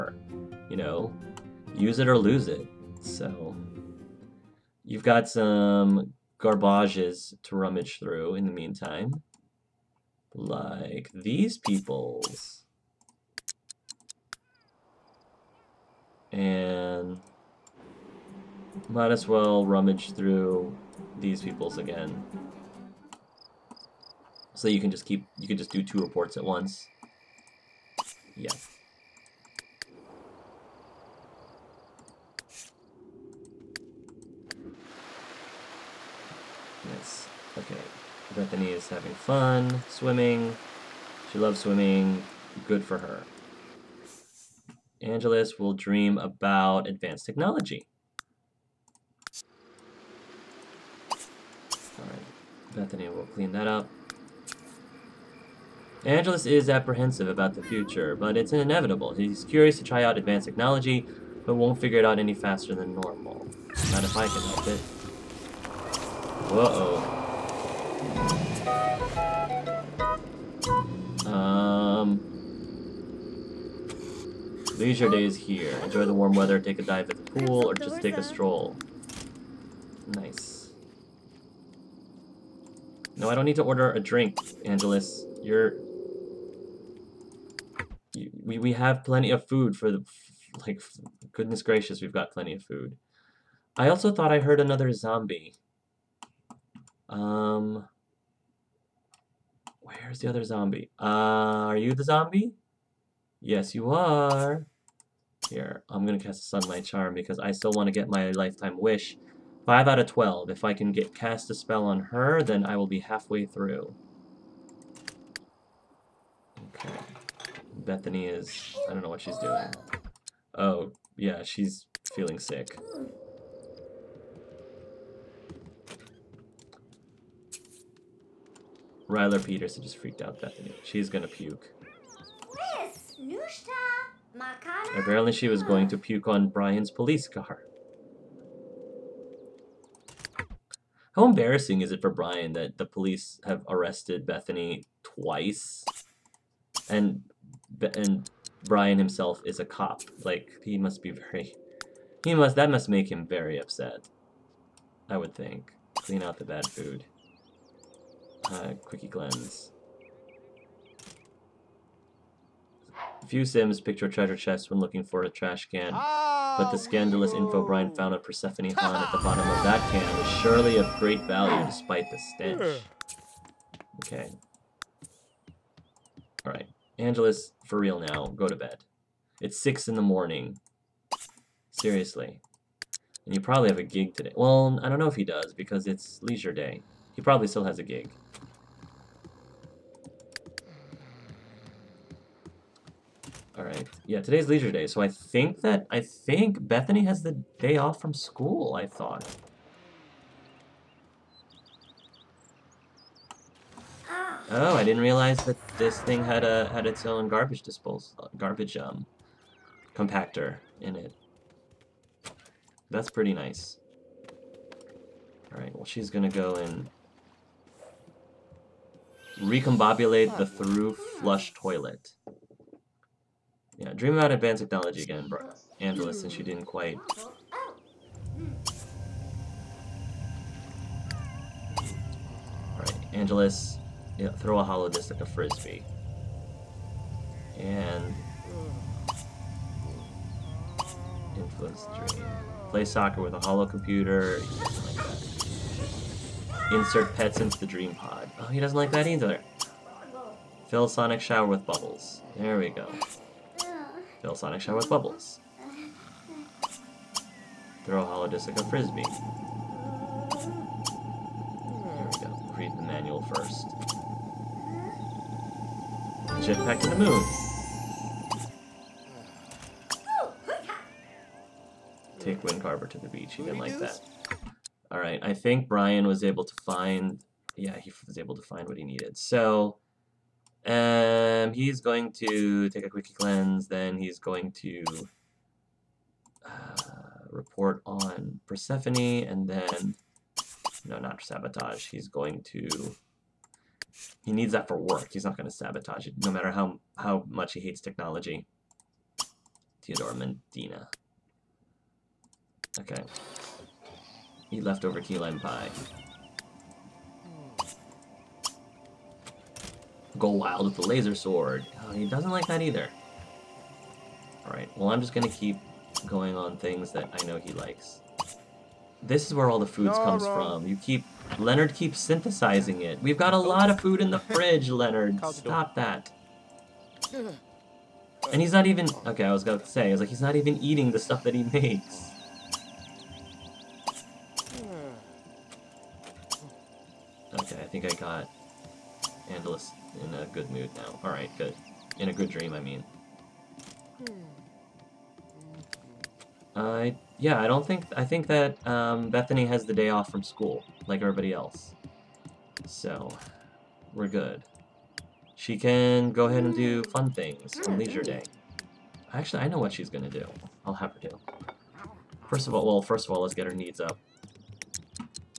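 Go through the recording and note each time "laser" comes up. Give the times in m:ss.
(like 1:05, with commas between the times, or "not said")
5:10.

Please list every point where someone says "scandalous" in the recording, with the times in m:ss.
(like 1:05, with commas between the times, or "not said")
2:46.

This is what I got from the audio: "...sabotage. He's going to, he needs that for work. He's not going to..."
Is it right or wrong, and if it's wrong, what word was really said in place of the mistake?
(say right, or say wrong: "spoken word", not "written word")
right.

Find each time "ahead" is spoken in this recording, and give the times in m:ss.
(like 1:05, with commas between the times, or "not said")
5:56.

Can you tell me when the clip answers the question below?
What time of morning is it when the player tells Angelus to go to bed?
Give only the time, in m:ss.
2:59.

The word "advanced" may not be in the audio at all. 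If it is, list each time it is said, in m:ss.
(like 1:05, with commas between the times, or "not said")
0:46, 1:00, 3:44.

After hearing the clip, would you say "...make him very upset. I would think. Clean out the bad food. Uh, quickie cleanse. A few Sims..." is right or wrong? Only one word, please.
right.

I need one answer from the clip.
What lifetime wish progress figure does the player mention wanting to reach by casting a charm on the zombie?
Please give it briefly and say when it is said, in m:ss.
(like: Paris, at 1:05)
5 out of 12, at 1:49.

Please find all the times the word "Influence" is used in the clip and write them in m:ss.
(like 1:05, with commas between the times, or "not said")
4:01.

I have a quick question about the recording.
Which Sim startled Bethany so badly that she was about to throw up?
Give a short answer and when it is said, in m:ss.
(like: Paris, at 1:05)
Ryler Peterson, at 2:09.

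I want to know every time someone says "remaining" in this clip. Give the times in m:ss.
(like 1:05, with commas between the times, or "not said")
not said.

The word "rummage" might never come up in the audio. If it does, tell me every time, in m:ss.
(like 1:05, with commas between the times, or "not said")
0:07, 0:19.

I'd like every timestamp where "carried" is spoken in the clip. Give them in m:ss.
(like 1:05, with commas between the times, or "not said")
not said.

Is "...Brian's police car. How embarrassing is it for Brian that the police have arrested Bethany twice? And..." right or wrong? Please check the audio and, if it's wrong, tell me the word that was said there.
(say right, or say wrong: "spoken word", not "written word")
right.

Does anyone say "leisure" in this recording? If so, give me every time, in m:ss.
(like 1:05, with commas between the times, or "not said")
1:14, 3:06, 3:14, 5:57.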